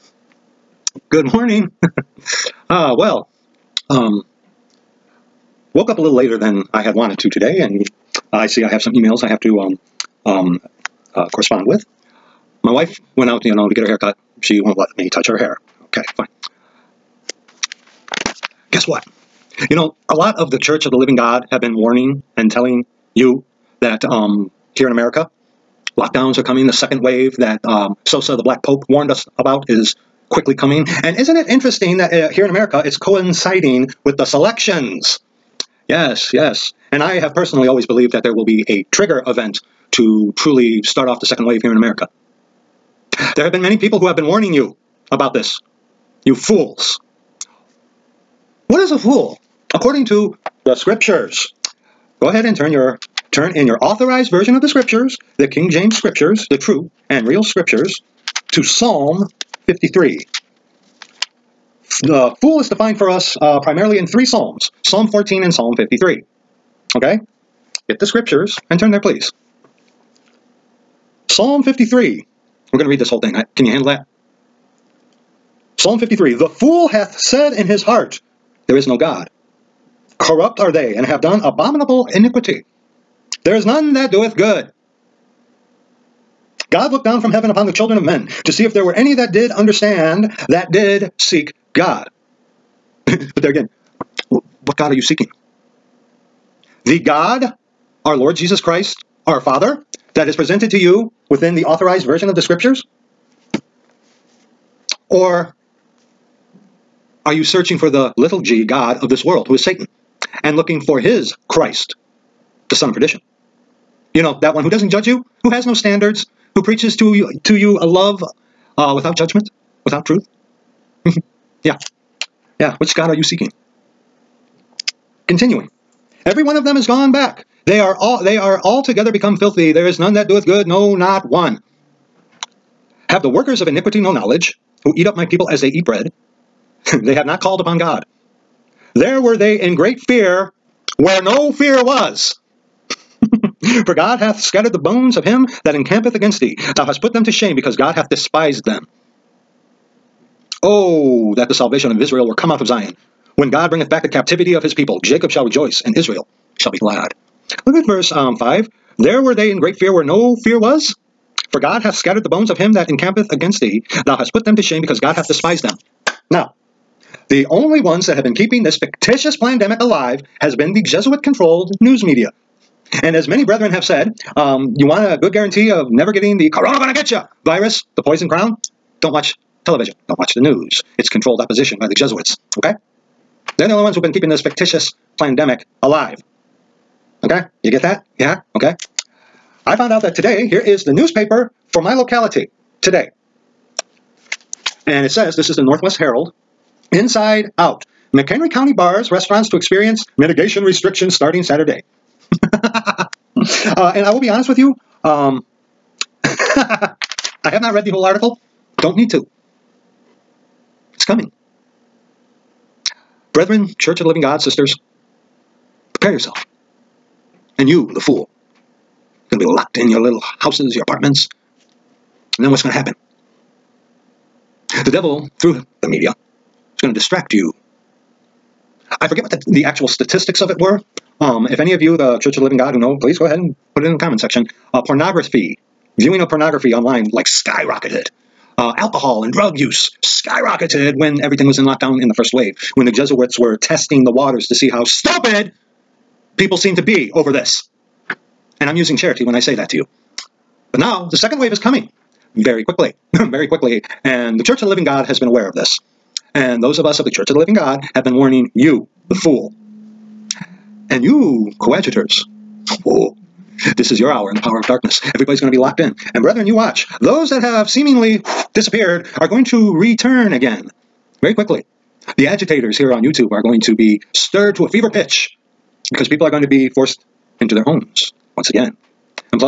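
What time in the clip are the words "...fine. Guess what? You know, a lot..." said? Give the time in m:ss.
0:16.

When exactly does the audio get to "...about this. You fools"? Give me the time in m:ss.
0:45.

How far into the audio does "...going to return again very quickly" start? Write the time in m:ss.
4:29.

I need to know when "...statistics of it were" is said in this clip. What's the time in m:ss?
3:49.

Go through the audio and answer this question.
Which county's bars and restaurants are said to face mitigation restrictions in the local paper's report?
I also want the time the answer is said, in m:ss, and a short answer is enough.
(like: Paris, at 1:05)
McHenry County, at 3:18.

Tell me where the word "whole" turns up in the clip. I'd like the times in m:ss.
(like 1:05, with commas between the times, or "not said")
1:13, 3:27.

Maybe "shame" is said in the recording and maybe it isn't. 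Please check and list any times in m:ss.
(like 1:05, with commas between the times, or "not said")
2:27, 2:44.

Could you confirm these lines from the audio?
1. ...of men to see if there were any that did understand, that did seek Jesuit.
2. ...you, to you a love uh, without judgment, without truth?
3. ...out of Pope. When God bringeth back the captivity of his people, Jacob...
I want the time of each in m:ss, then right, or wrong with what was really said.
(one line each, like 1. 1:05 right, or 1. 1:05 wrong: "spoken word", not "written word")
1. 1:27 wrong: "God", not "Jesuit"
2. 1:57 right
3. 2:32 wrong: "Zion", not "Pope".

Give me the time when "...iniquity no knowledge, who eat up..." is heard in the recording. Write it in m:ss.
2:13.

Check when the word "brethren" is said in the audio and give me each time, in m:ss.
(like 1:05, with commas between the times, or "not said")
2:53, 3:33, 4:26.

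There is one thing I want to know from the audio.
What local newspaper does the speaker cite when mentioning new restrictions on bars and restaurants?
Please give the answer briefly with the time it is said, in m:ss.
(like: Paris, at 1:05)
Northwest Herald, at 3:15.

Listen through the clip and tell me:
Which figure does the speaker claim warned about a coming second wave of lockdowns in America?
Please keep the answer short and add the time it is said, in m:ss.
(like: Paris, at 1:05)
Sosa, at 0:28.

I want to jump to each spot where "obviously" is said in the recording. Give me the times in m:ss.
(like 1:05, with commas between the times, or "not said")
not said.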